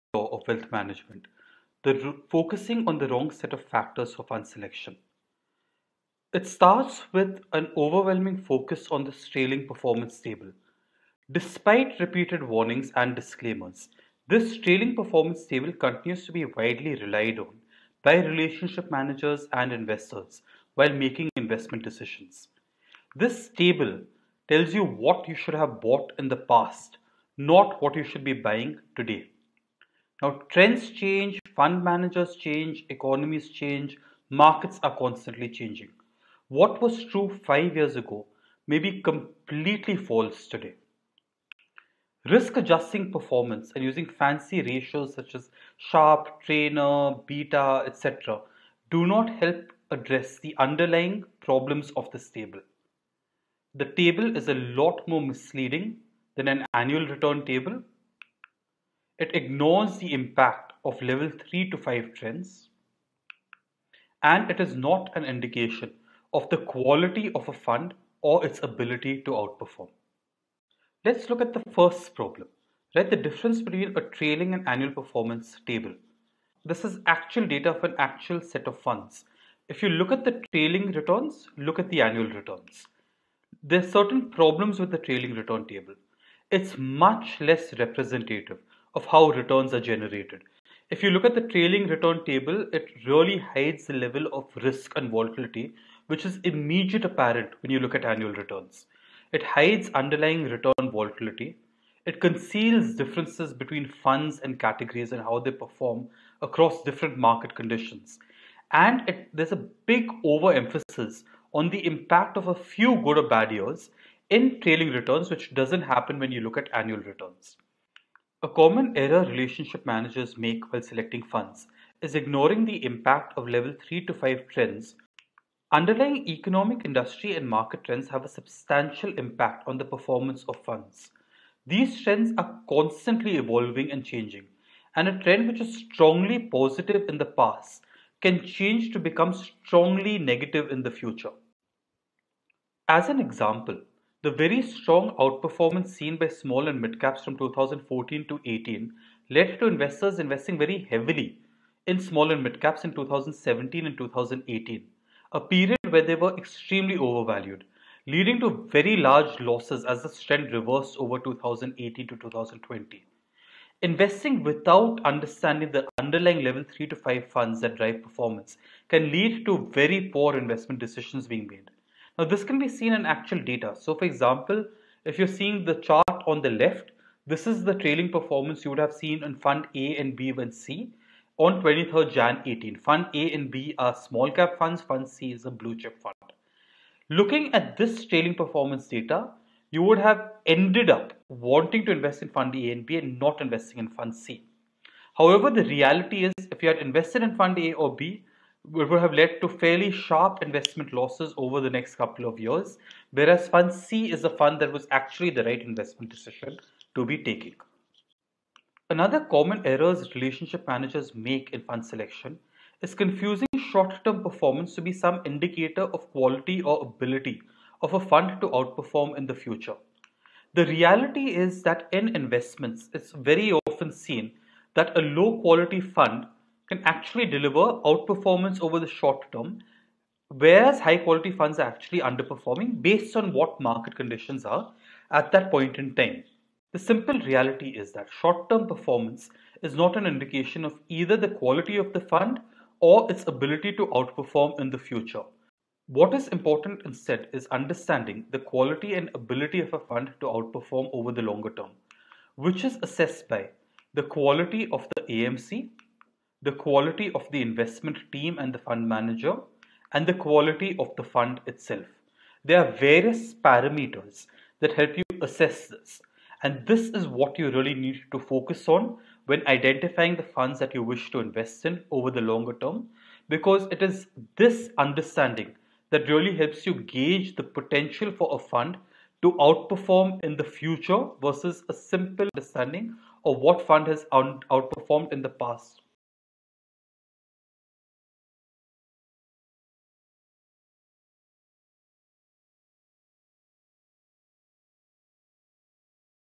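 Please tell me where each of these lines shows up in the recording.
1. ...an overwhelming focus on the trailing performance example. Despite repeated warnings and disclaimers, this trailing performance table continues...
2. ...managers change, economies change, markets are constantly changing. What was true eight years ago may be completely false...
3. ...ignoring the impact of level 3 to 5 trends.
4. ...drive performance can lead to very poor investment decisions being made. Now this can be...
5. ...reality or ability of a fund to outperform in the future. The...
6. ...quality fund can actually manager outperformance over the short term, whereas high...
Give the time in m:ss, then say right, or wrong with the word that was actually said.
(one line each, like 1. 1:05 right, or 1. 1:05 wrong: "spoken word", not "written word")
1. 0:07 wrong: "table", not "example"
2. 0:31 wrong: "five", not "eight"
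3. 2:02 right
4. 2:47 right
5. 3:36 wrong: "quality", not "reality"
6. 3:45 wrong: "deliver", not "manager".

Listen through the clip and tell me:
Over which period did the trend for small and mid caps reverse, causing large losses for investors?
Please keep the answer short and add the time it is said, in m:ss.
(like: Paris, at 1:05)
2018 to 2020, at 2:41.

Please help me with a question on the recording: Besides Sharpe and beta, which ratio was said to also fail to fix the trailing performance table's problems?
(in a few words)
Treynor.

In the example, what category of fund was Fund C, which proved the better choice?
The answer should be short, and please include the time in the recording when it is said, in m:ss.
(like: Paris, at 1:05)
blue chip fund, at 3:05.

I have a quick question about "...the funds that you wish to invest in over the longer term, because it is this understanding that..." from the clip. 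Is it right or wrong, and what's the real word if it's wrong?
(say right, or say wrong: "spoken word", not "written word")
right.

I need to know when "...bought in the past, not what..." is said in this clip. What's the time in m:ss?
0:25.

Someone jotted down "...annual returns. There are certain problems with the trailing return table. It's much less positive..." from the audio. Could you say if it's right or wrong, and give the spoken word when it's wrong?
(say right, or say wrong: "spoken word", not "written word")
wrong: "representative", not "positive".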